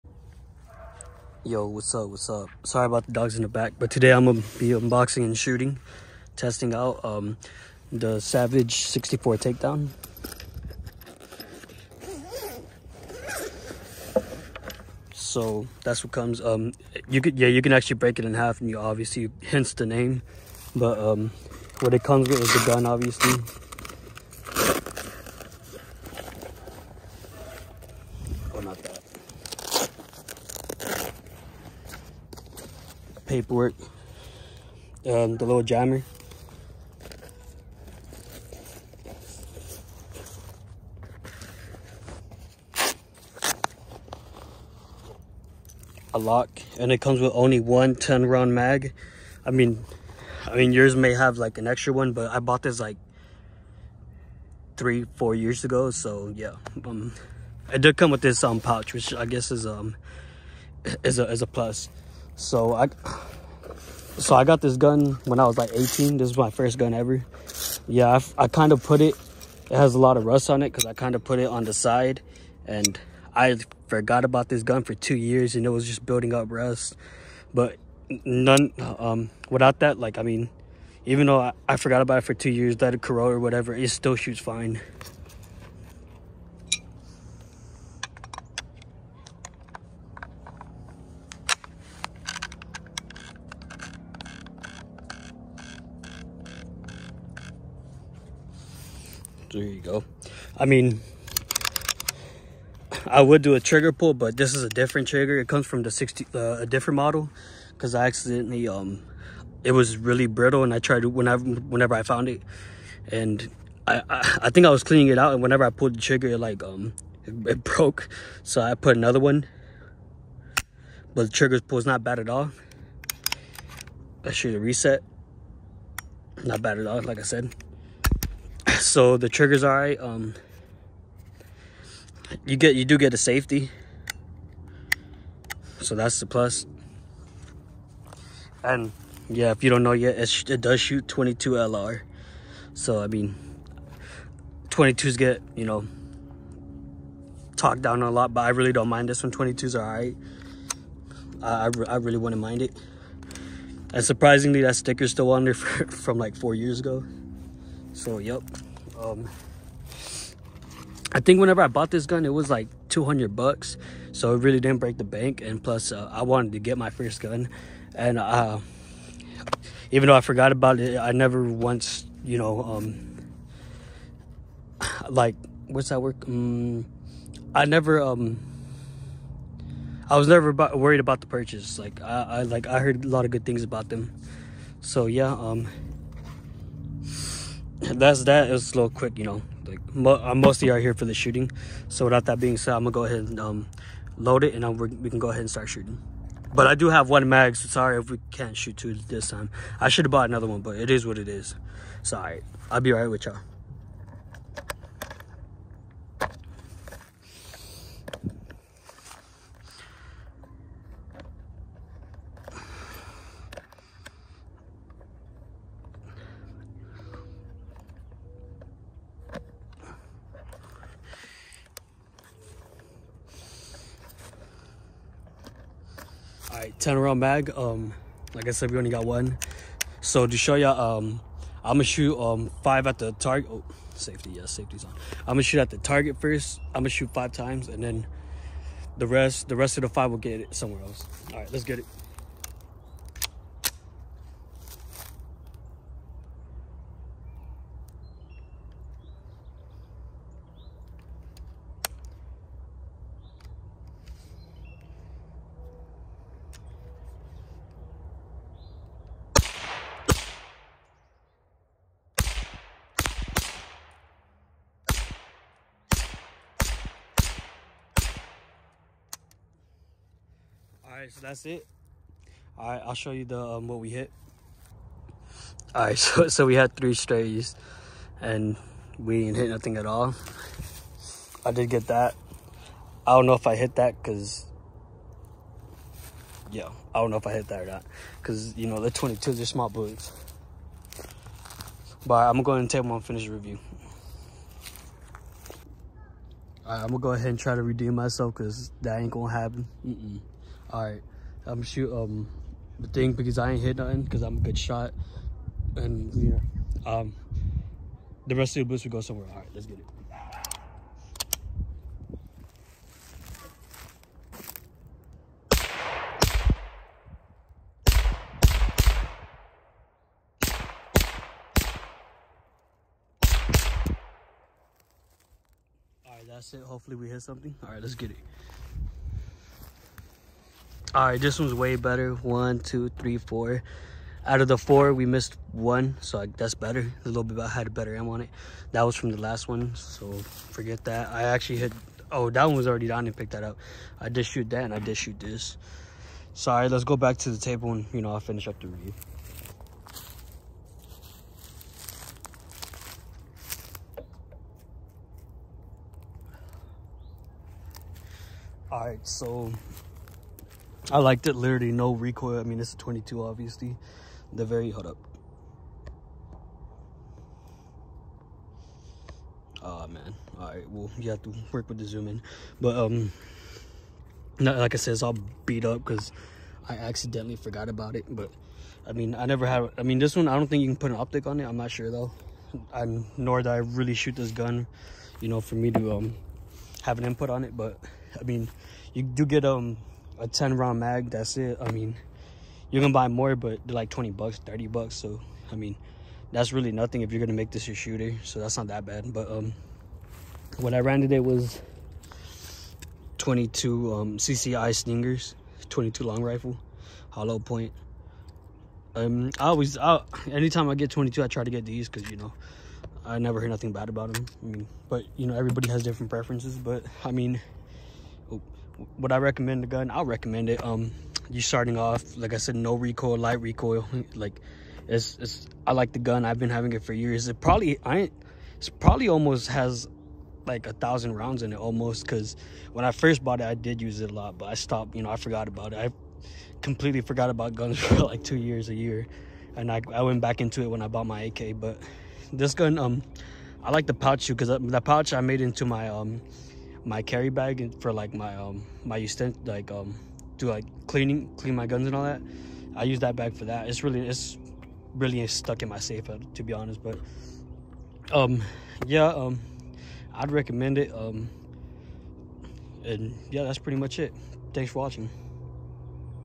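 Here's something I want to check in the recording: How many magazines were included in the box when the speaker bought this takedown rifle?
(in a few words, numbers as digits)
1.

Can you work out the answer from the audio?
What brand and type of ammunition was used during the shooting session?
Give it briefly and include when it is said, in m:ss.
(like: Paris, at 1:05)
CCI Stingers, at 6:44.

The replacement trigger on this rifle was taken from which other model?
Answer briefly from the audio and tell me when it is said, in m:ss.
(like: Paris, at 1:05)
the 60, at 1:45.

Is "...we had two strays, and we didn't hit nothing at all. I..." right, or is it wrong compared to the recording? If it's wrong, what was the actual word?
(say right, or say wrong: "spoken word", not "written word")
wrong: "three", not "two".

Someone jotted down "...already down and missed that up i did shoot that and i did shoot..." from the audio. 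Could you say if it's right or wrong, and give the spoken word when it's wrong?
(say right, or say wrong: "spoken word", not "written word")
wrong: "picked", not "missed".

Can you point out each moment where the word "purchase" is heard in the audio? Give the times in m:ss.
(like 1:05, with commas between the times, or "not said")
3:01.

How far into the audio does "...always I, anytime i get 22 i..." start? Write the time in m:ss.
6:49.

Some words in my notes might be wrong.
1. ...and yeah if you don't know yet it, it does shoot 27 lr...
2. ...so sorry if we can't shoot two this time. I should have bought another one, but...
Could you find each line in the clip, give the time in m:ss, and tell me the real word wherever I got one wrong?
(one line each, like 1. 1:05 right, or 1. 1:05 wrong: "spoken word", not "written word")
1. 2:18 wrong: "22", not "27"
2. 3:17 right.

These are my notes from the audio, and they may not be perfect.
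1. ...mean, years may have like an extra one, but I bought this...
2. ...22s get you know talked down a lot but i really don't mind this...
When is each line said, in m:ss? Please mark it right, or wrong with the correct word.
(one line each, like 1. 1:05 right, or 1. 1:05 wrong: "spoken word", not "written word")
1. 0:50 wrong: "yours", not "years"
2. 2:24 right.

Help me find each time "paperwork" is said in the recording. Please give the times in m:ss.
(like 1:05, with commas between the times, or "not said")
0:33.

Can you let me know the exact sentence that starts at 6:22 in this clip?
I'm nor did I really shoot this gun, you know, for me to, um, have an input on it.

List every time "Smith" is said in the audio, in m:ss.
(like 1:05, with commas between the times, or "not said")
not said.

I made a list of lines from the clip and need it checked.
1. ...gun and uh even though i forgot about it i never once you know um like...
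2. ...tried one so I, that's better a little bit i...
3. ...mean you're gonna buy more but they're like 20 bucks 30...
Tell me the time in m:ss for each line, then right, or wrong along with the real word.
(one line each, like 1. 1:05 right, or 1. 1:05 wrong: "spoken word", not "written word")
1. 2:47 right
2. 5:35 wrong: "missed", not "tried"
3. 6:31 right.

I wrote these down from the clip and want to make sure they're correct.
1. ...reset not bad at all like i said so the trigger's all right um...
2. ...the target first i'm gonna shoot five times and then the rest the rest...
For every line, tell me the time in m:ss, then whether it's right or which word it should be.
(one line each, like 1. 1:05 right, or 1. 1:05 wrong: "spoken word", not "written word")
1. 2:04 right
2. 3:55 right.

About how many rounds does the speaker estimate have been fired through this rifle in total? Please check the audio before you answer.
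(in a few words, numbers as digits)
1,000.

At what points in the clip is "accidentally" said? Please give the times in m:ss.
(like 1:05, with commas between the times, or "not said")
1:48, 6:16.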